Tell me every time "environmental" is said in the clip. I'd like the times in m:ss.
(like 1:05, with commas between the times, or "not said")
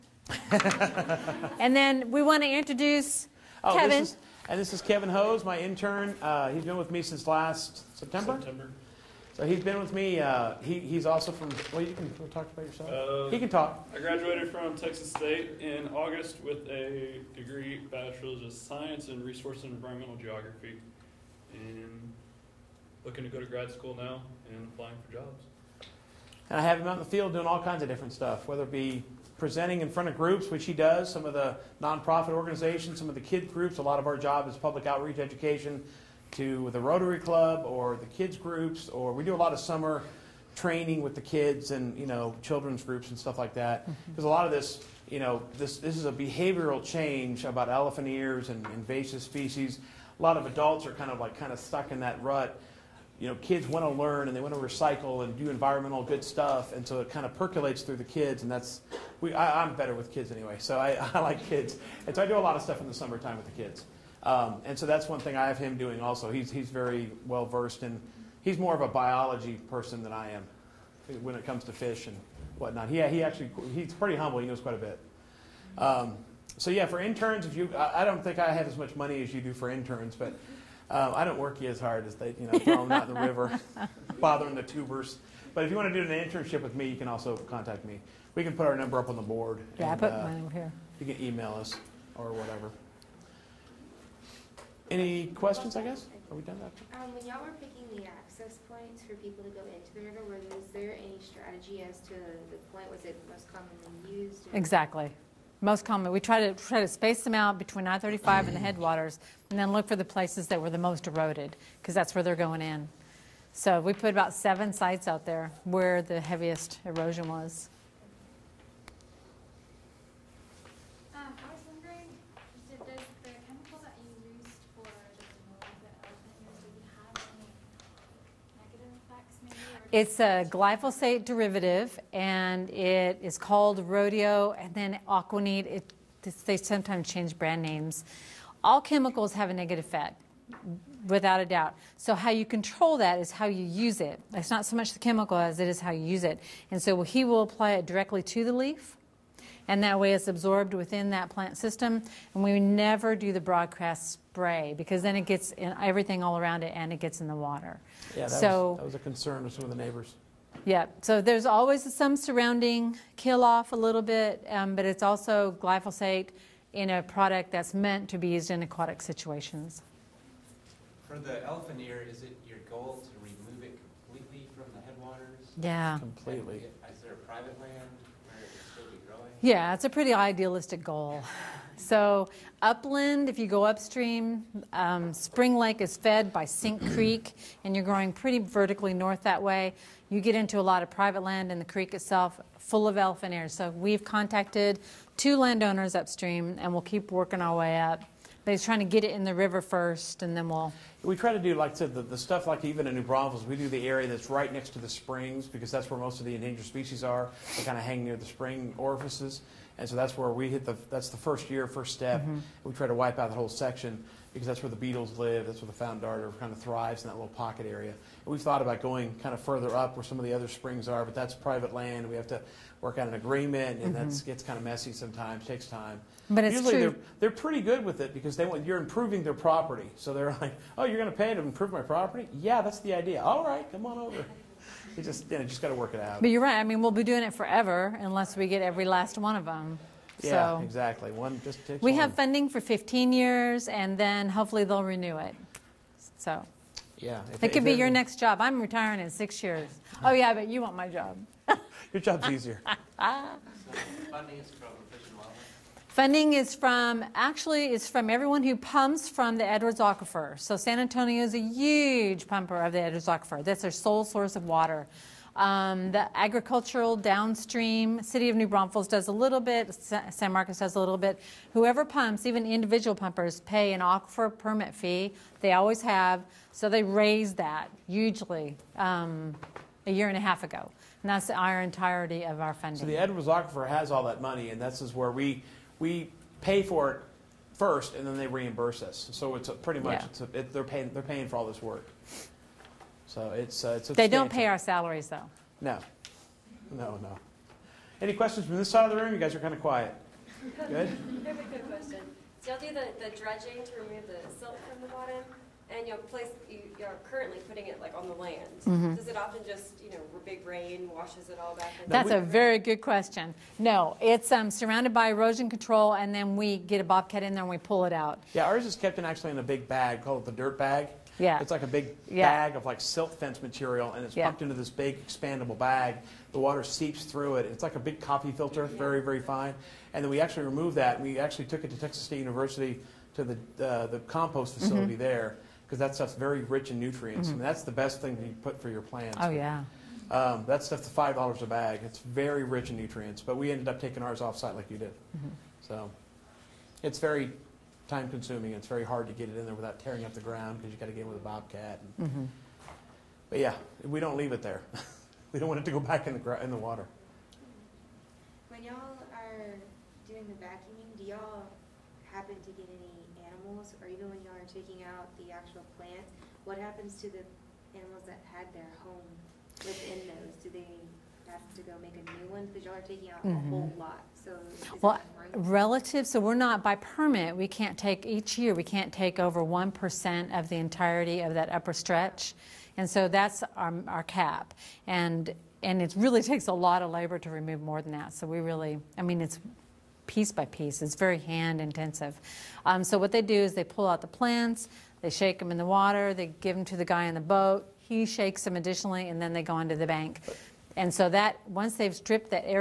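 0:19, 0:55.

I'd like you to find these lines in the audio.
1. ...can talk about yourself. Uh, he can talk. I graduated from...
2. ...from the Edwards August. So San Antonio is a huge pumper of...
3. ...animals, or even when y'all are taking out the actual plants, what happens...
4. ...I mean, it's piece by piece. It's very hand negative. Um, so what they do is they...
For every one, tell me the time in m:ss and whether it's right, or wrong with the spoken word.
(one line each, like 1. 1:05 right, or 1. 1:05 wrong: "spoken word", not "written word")
1. 0:11 right
2. 4:19 wrong: "Aquifer", not "August"
3. 6:03 right
4. 6:28 wrong: "intensive", not "negative".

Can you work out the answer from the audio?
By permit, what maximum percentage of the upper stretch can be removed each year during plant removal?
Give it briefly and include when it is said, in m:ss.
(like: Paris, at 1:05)
1%, at 6:19.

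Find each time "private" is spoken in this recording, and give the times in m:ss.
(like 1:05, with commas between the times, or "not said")
2:57, 3:10, 3:41.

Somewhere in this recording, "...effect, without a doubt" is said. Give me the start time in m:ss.
2:19.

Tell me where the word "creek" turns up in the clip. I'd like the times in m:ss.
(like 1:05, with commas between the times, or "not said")
3:06, 3:11.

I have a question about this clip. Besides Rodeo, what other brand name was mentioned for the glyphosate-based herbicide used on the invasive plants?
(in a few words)
AquaNeat.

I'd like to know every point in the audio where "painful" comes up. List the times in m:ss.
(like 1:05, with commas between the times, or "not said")
not said.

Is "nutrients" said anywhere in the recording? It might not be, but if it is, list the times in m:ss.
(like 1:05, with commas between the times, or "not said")
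5:36, 5:42.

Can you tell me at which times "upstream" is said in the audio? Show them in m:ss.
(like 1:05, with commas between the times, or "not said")
3:03, 3:15.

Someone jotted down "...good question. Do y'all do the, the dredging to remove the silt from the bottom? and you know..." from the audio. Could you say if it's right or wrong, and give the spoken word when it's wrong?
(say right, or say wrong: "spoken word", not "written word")
right.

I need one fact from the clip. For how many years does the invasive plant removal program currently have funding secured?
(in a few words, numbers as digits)
15 years.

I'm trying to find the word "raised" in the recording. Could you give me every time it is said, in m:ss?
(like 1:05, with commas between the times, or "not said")
4:36.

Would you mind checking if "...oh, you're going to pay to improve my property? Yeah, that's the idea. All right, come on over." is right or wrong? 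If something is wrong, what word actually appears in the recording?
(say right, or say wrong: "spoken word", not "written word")
right.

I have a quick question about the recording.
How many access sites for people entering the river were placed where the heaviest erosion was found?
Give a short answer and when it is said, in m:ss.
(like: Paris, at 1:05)
7, at 1:54.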